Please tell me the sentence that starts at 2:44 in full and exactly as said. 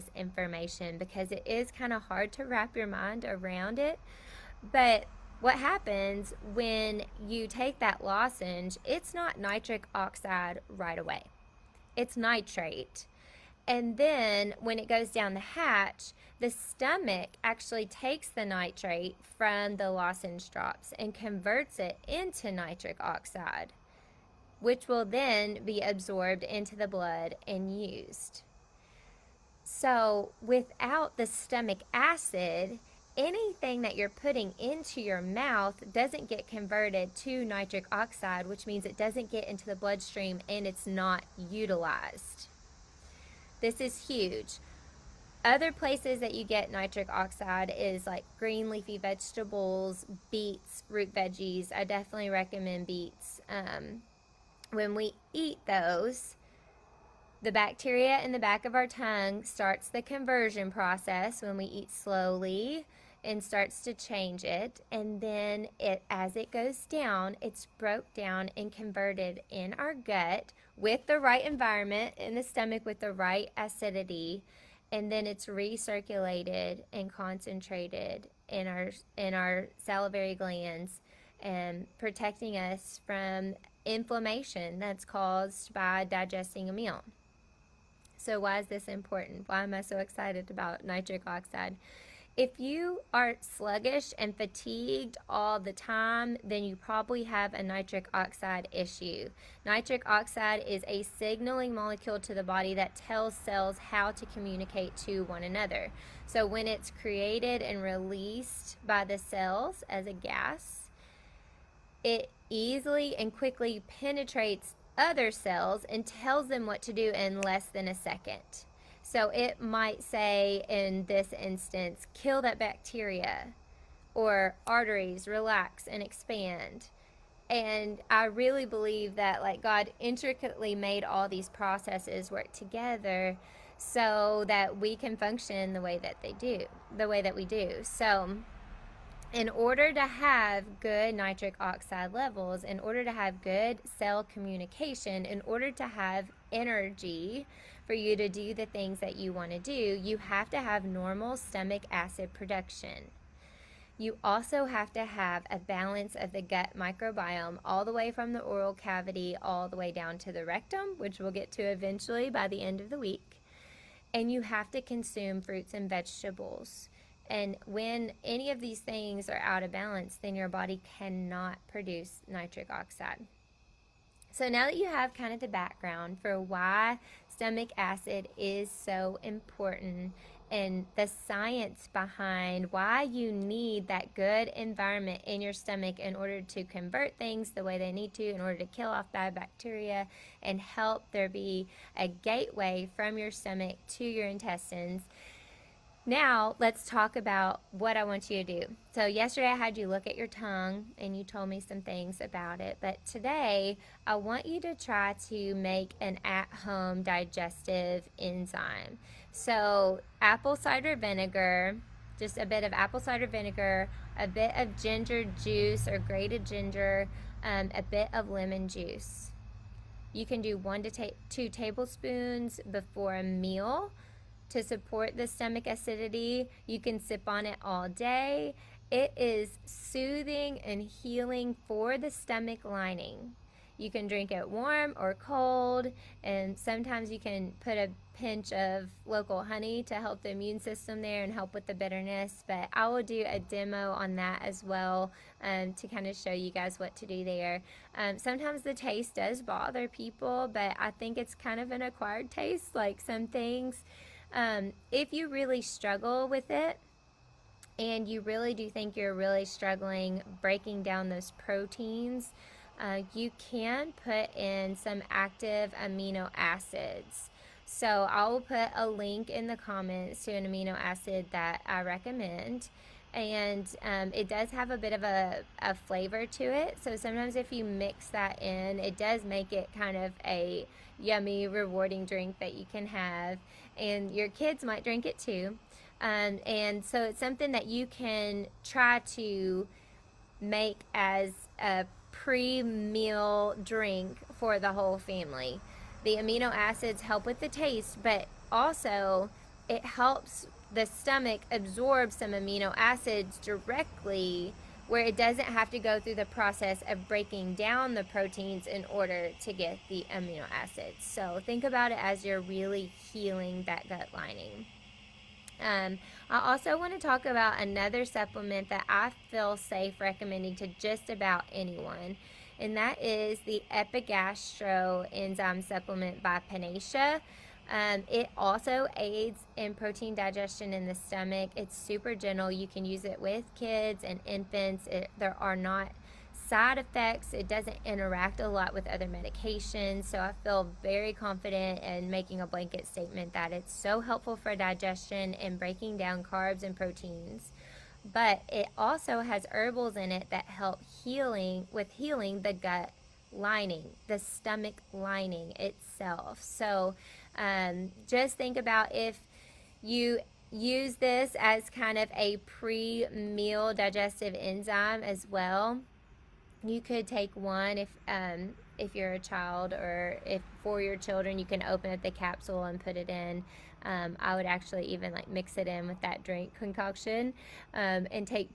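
And you have to consume fruits and vegetables.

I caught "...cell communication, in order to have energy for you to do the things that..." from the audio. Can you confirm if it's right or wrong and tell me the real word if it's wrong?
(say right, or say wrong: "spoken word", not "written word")
right.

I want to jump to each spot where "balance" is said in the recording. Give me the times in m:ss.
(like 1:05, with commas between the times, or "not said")
2:35, 2:49.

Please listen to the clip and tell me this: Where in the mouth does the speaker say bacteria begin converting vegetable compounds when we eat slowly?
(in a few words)
Back of our tongue.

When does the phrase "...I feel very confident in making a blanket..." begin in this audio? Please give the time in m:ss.
5:40.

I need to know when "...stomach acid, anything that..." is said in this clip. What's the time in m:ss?
0:31.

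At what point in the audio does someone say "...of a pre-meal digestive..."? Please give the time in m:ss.
6:01.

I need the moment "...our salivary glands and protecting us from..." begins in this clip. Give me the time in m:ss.
1:19.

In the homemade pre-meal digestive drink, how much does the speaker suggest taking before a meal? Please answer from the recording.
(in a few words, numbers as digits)
1 to 2 tablespoons.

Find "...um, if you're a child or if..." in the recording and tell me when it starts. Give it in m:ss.
6:08.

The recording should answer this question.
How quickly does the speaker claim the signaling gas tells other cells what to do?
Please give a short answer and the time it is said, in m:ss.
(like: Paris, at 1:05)
Less than a second, at 1:57.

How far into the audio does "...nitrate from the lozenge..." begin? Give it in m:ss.
0:18.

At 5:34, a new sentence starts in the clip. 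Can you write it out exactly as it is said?
It, there are not side effects.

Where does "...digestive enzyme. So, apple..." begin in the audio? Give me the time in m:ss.
3:27.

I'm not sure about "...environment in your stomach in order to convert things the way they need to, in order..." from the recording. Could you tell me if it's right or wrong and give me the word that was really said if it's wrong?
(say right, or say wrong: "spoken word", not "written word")
right.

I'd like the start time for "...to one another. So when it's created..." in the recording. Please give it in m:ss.
1:44.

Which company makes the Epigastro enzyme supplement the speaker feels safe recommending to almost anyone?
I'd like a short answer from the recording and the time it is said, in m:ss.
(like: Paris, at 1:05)
Panacea, at 5:26.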